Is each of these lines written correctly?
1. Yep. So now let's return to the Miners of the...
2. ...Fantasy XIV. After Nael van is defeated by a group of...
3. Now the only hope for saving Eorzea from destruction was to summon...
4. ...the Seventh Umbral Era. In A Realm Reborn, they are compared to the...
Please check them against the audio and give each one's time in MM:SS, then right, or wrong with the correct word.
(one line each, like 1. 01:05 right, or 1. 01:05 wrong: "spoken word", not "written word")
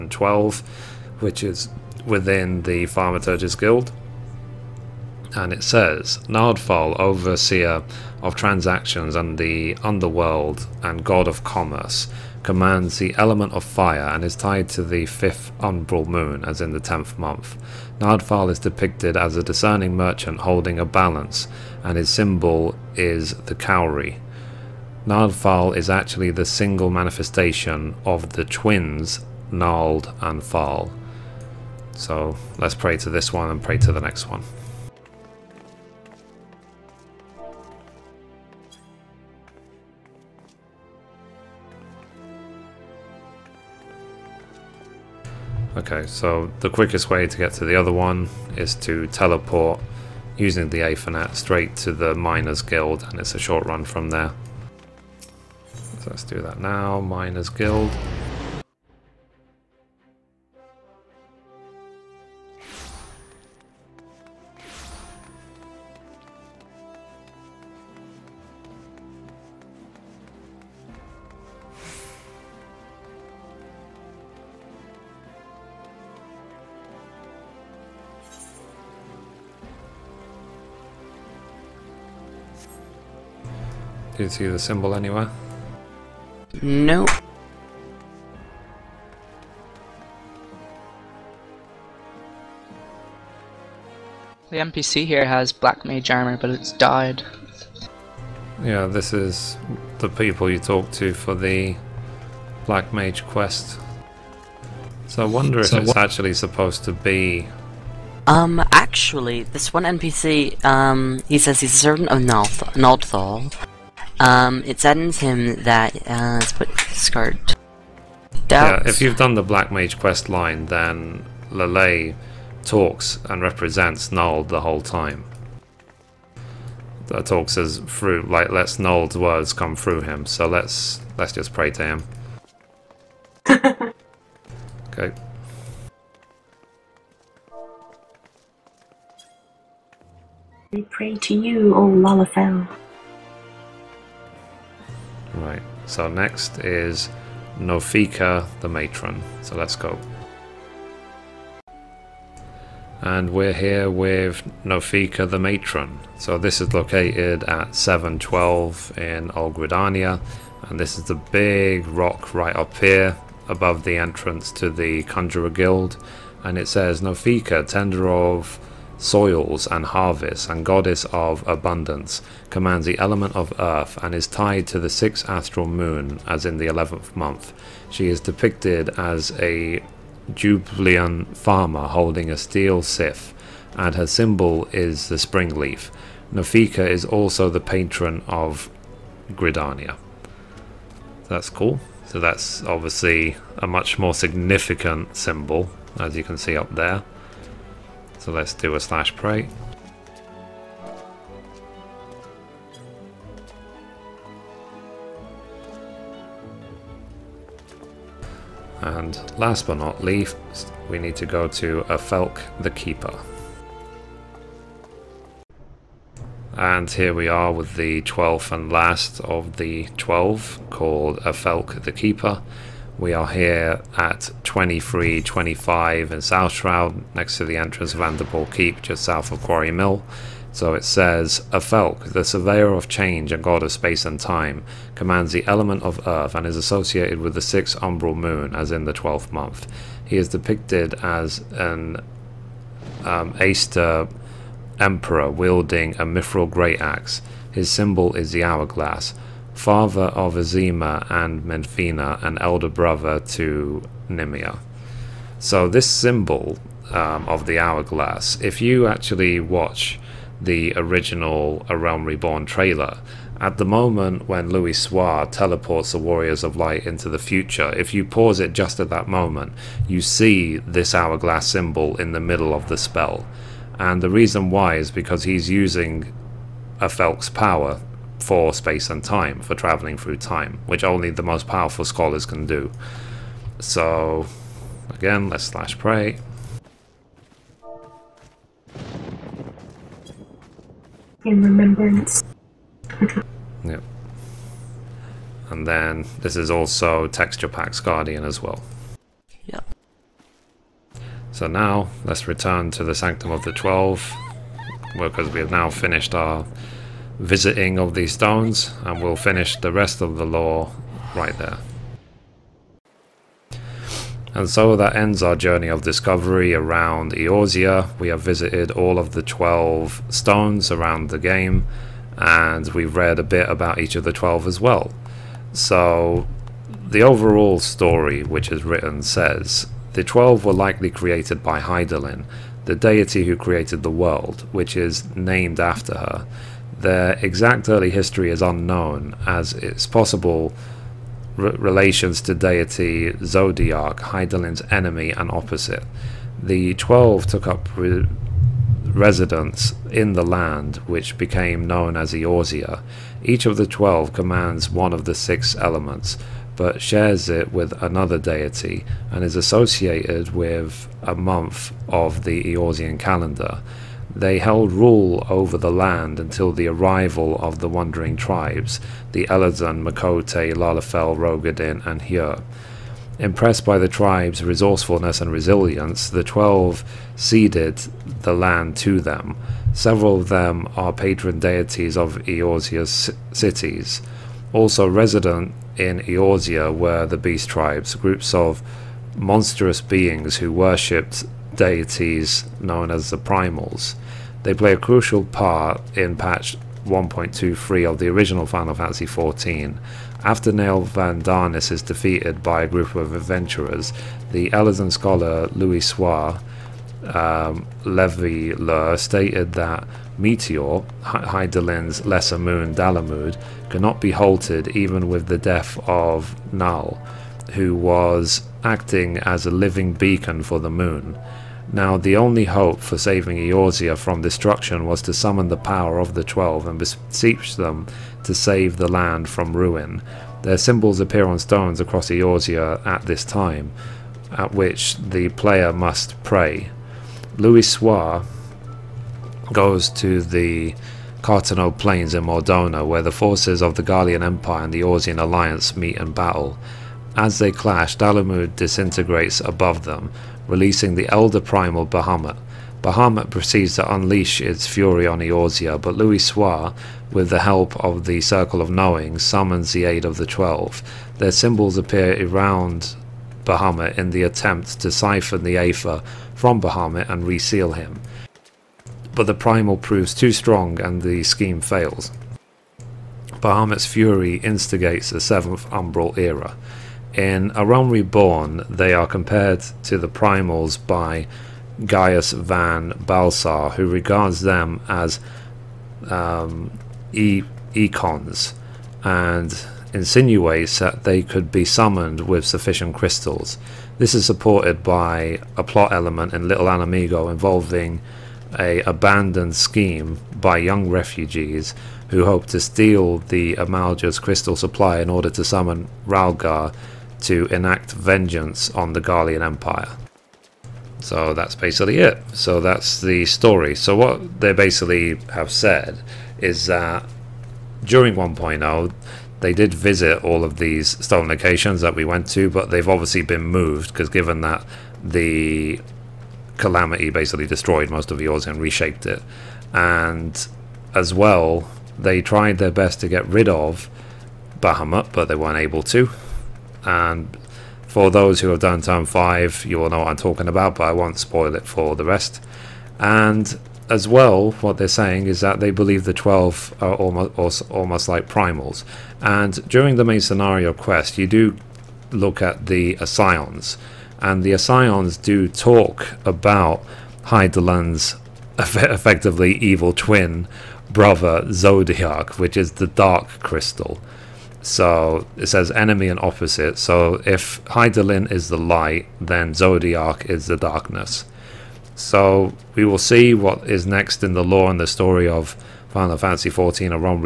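1. 04:59 wrong: "Sanctum", not "Miners"
2. 06:38 right
3. 07:01 right
4. 07:55 right.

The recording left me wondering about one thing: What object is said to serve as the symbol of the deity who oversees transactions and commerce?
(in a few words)
Cowrie.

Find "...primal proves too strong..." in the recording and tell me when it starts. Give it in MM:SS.
07:49.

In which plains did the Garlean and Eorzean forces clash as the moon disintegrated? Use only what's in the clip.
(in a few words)
Carteneau Plains.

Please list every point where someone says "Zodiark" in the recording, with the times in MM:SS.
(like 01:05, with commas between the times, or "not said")
05:43, 09:21, 09:29.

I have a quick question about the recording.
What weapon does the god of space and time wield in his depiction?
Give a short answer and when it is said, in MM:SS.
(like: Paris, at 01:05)
Mithril great axe, at 04:06.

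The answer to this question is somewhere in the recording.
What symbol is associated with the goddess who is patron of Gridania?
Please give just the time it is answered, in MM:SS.
03:05.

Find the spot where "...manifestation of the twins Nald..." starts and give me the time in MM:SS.
00:26.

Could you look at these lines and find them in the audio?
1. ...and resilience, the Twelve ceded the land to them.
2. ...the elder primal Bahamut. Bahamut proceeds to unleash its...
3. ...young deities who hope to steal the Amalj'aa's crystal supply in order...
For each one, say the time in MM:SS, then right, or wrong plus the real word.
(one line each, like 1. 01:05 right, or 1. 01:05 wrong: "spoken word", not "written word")
1. 06:15 right
2. 07:30 right
3. 08:20 wrong: "refugees", not "deities".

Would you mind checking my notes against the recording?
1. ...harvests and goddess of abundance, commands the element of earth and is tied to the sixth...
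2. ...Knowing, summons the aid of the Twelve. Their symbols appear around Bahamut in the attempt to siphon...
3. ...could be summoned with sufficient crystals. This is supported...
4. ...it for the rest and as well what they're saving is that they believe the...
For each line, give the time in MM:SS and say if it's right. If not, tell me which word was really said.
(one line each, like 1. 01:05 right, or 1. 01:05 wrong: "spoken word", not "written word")
1. 02:49 right
2. 07:38 right
3. 08:11 right
4. 09:01 wrong: "saying", not "saving".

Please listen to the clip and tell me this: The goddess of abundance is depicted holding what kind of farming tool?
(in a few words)
Steel scythe.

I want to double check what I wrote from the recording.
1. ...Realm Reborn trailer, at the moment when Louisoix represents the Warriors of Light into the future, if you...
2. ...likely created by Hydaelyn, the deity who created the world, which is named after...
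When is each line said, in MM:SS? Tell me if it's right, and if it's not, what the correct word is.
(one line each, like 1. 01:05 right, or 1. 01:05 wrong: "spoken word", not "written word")
1. 04:21 wrong: "teleports", not "represents"
2. 05:30 right.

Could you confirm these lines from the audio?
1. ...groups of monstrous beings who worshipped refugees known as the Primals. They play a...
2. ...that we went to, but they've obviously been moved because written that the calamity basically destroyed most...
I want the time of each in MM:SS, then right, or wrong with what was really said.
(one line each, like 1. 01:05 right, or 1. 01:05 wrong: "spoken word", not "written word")
1. 06:27 wrong: "deities", not "refugees"
2. 08:41 wrong: "given", not "written".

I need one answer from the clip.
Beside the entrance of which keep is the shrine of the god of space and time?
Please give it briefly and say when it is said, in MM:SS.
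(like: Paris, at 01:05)
Anderpool Keep, at 03:47.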